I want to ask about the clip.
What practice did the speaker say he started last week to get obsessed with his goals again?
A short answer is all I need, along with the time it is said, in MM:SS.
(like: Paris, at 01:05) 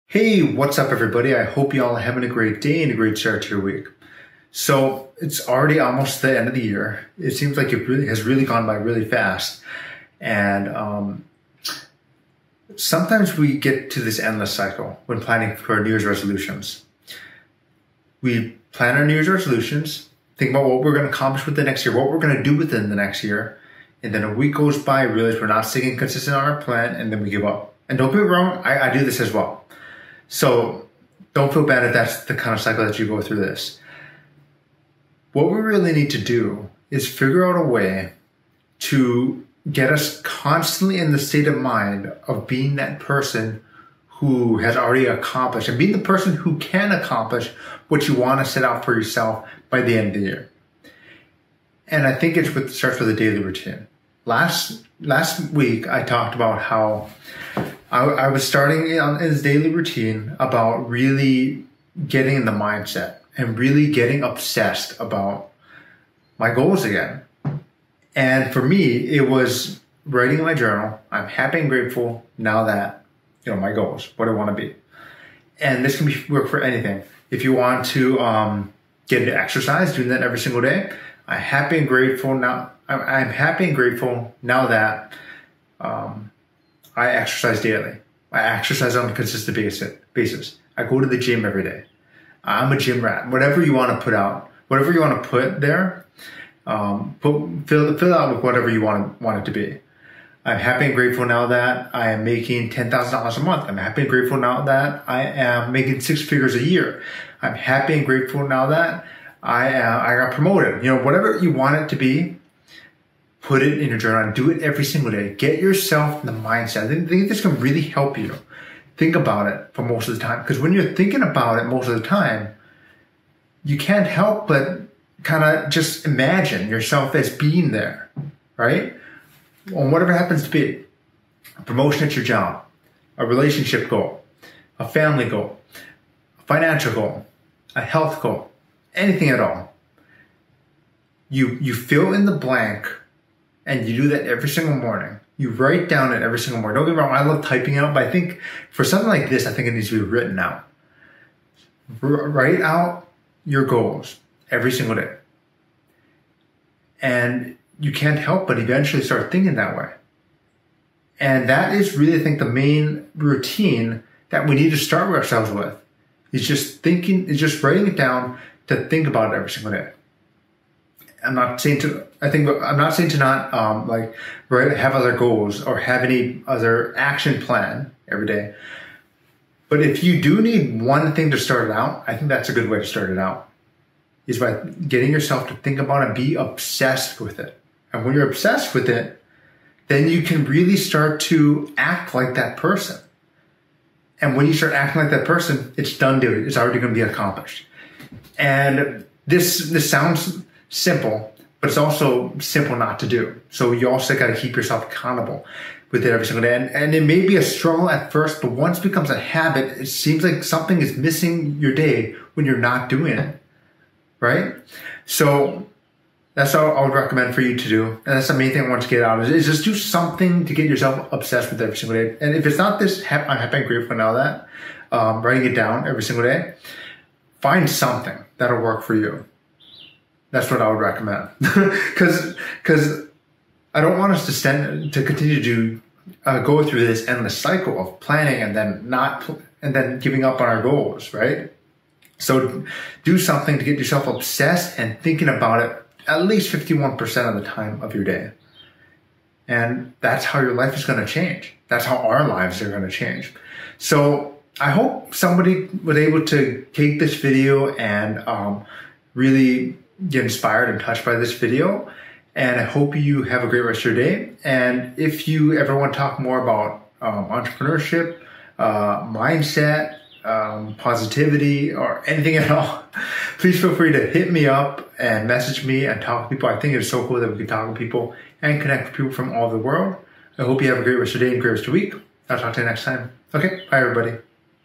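writing my journal, at 01:10.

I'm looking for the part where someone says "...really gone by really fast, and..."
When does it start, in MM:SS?
00:08.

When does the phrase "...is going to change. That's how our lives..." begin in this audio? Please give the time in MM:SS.
04:10.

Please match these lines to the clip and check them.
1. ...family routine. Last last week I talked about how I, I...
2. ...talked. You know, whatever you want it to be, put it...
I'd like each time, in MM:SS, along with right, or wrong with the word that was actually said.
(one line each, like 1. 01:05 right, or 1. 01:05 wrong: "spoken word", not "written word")
1. 00:53 wrong: "daily", not "family"
2. 01:50 wrong: "promoted", not "talked".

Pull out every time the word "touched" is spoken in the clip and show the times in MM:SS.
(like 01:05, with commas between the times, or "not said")
04:20.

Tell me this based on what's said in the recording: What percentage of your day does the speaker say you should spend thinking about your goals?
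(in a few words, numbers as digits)
51%.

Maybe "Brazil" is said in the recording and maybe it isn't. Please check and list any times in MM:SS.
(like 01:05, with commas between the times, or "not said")
not said.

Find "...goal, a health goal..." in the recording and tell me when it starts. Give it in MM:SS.
02:16.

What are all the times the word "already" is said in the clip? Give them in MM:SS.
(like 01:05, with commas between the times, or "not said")
00:05, 00:44, 03:16.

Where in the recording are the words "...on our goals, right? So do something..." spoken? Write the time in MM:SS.
04:00.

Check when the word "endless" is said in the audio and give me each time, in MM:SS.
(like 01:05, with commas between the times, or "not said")
00:14, 03:57.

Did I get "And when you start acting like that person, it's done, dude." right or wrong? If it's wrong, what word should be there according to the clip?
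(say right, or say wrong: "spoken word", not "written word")
right.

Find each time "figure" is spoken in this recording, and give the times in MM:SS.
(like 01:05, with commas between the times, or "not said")
00:37, 01:46.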